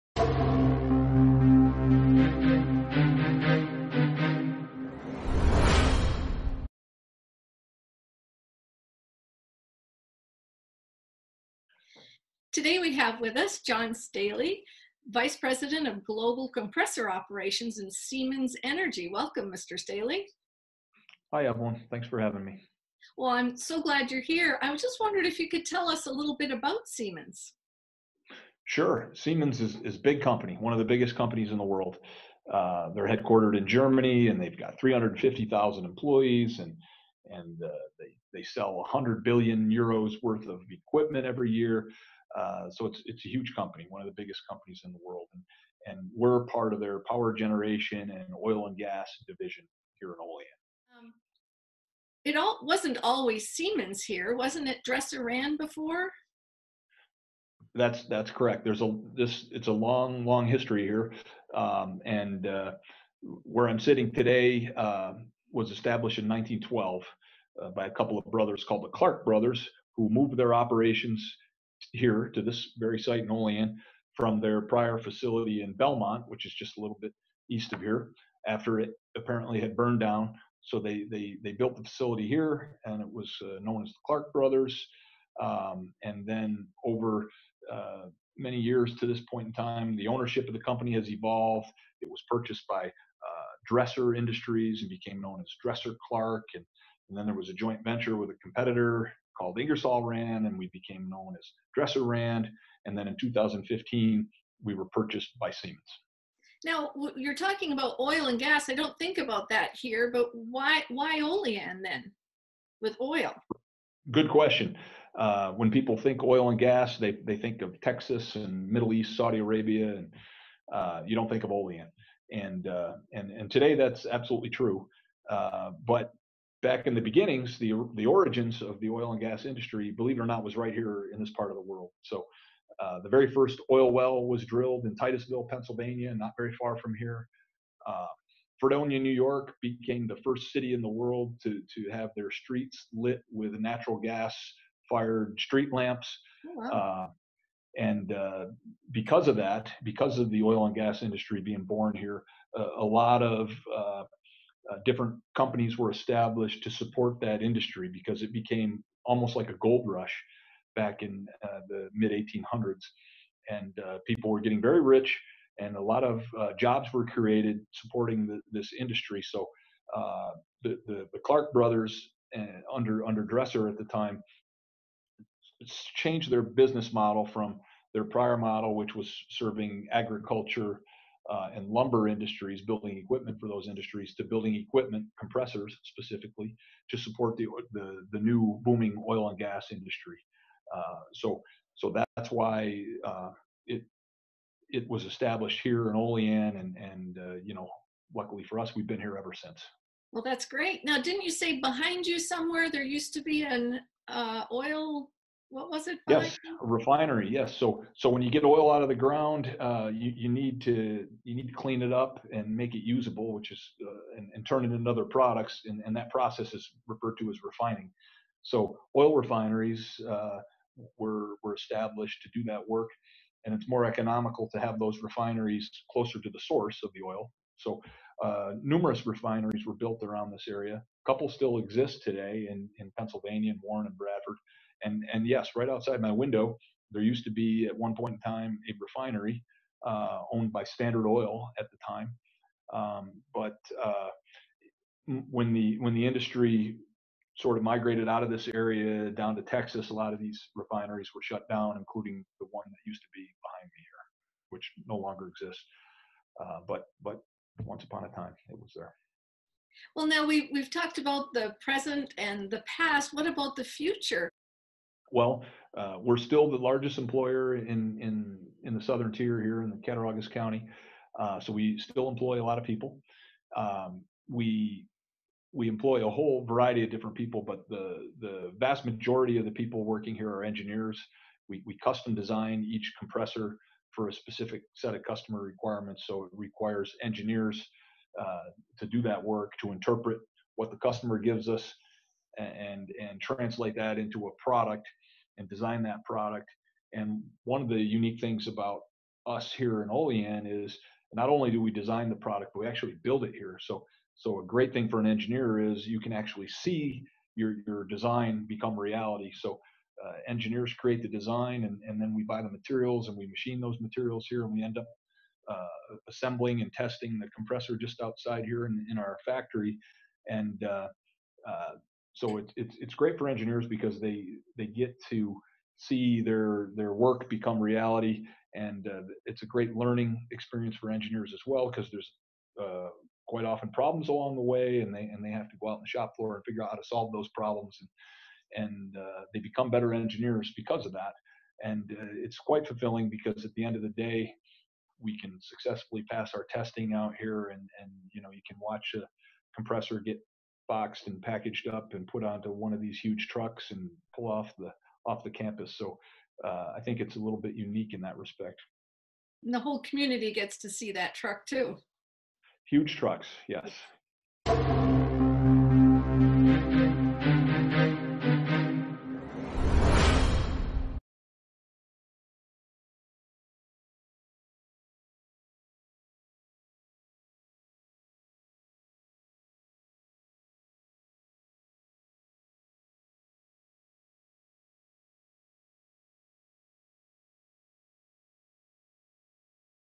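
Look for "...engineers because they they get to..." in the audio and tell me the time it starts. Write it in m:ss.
5:23.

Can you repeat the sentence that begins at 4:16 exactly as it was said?
Uh, but but once upon a time, it was there.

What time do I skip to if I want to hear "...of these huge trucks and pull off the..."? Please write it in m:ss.
5:52.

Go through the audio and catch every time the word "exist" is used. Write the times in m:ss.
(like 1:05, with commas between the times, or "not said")
3:51, 4:15.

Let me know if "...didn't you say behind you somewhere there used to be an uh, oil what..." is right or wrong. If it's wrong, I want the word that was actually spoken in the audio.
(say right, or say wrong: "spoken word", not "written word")
right.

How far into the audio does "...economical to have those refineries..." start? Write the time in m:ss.
3:43.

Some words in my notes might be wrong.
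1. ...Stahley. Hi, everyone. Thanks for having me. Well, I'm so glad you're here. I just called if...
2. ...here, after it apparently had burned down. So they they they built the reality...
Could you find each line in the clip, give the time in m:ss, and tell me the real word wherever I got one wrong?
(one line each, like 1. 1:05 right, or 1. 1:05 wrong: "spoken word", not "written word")
1. 0:19 wrong: "wondered", not "called"
2. 1:17 wrong: "facility", not "reality".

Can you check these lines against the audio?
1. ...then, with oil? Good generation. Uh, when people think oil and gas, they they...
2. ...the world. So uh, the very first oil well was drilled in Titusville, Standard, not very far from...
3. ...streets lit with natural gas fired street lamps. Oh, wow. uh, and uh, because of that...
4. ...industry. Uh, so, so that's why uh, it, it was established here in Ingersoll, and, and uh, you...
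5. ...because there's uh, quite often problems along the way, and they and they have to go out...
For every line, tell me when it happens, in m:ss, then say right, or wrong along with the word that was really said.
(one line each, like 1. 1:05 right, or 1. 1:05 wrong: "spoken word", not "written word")
1. 1:51 wrong: "question", not "generation"
2. 2:11 wrong: "Pennsylvania", not "Standard"
3. 2:22 right
4. 3:09 wrong: "Olean", not "Ingersoll"
5. 5:31 right.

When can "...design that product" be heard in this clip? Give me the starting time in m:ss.
4:55.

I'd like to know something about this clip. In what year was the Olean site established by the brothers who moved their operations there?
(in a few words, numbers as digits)
1912.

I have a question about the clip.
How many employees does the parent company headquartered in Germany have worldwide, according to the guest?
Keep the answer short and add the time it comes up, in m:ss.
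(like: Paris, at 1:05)
350,000, at 0:34.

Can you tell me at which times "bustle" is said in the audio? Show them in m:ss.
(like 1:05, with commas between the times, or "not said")
not said.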